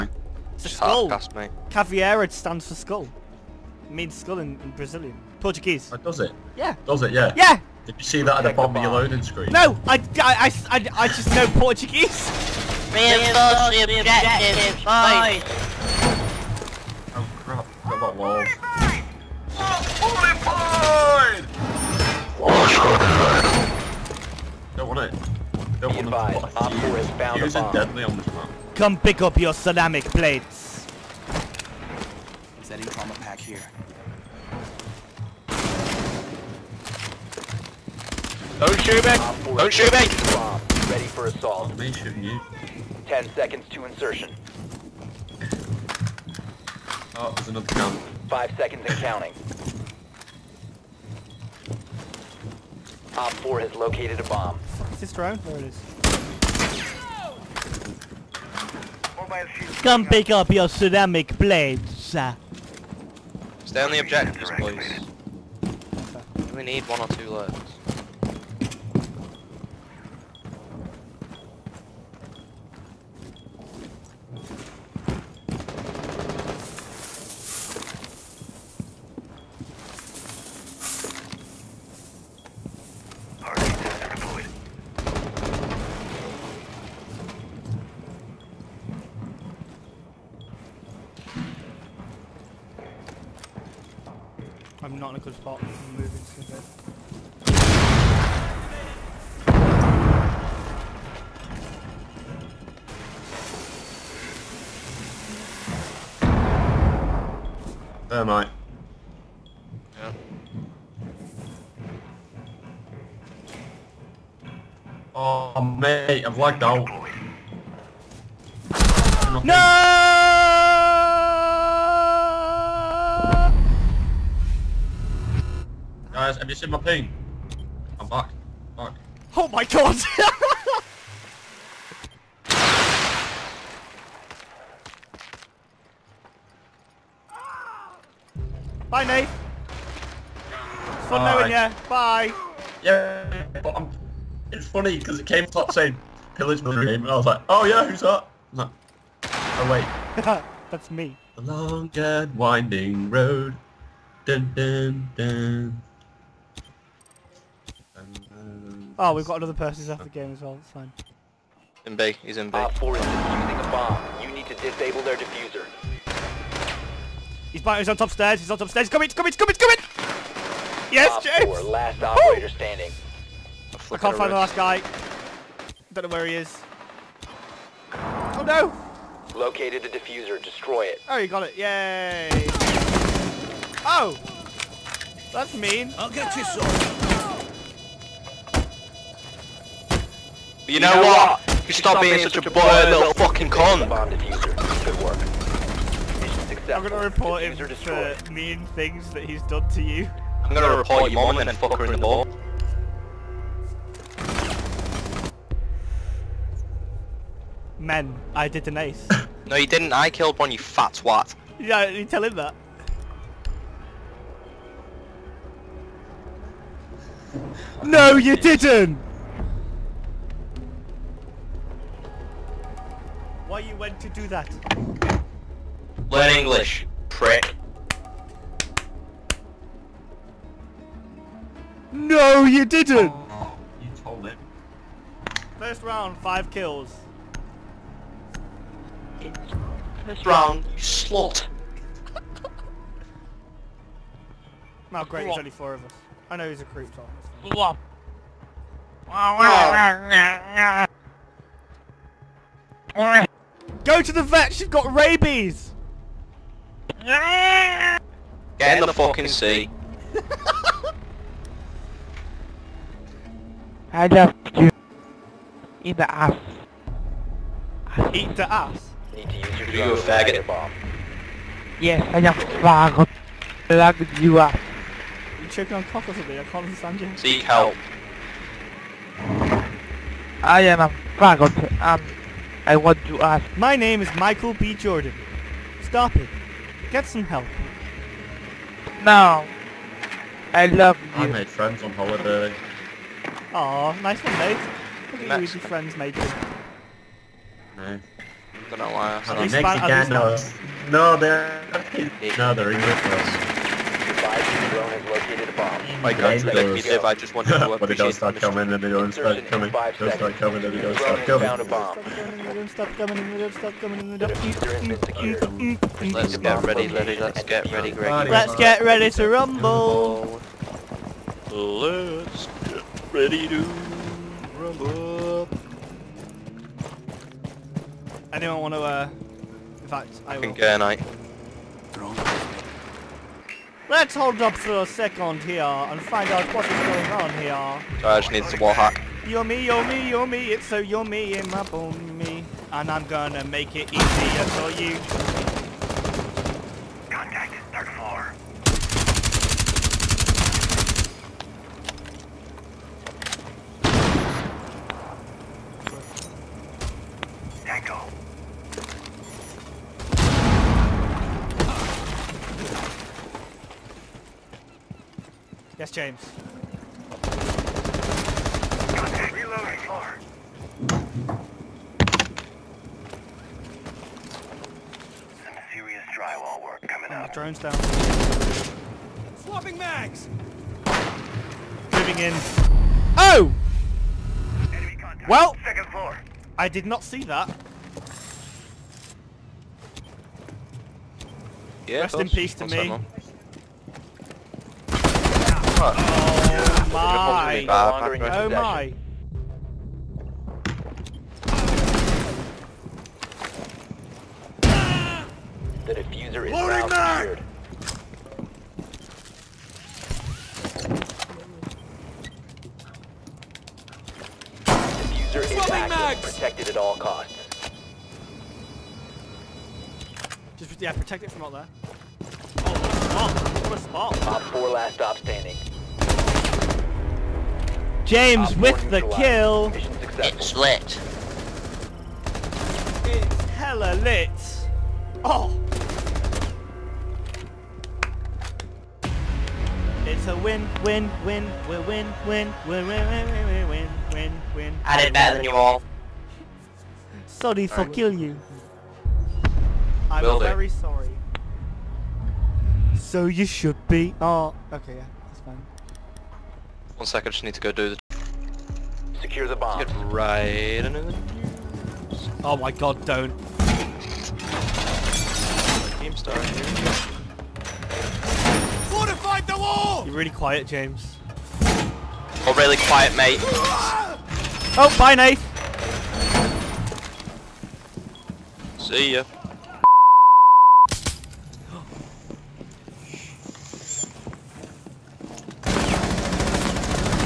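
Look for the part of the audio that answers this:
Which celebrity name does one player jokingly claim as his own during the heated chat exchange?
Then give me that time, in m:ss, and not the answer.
4:44.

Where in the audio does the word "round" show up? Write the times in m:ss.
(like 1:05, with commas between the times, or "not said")
3:55, 4:00.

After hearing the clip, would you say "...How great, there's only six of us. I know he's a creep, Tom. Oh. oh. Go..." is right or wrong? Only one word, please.
wrong.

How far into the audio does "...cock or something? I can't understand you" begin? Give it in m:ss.
4:35.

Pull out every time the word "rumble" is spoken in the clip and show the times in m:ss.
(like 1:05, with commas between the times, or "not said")
5:19, 5:24.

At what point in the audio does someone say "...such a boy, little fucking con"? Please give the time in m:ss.
3:12.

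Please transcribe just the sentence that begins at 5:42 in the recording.
And I'm gonna make it easier for you.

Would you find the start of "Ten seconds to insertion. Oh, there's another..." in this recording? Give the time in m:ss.
0:43.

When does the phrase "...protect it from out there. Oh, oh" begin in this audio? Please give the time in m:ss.
7:00.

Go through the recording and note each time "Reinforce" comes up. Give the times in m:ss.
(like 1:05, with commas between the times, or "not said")
0:12.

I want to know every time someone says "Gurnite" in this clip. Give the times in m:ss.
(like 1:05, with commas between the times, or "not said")
5:30.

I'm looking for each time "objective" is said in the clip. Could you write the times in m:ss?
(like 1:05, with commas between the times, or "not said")
0:13, 1:03.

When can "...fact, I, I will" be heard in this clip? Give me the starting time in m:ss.
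5:29.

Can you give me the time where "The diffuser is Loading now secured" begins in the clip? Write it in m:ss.
6:45.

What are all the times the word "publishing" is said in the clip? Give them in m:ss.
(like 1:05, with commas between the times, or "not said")
not said.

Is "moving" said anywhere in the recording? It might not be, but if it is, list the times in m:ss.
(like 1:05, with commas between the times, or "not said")
1:35, 6:21.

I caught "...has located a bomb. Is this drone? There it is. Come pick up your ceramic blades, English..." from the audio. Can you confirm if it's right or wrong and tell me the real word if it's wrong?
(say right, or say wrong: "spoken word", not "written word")
wrong: "Stay", not "English".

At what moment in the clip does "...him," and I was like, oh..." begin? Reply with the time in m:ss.
2:26.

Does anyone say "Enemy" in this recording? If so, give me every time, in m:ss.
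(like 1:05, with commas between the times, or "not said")
6:24.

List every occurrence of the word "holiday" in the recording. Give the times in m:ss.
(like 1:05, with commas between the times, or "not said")
4:51.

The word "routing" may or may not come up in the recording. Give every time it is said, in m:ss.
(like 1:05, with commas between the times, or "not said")
not said.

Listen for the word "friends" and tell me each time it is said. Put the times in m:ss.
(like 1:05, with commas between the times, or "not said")
4:51, 4:55.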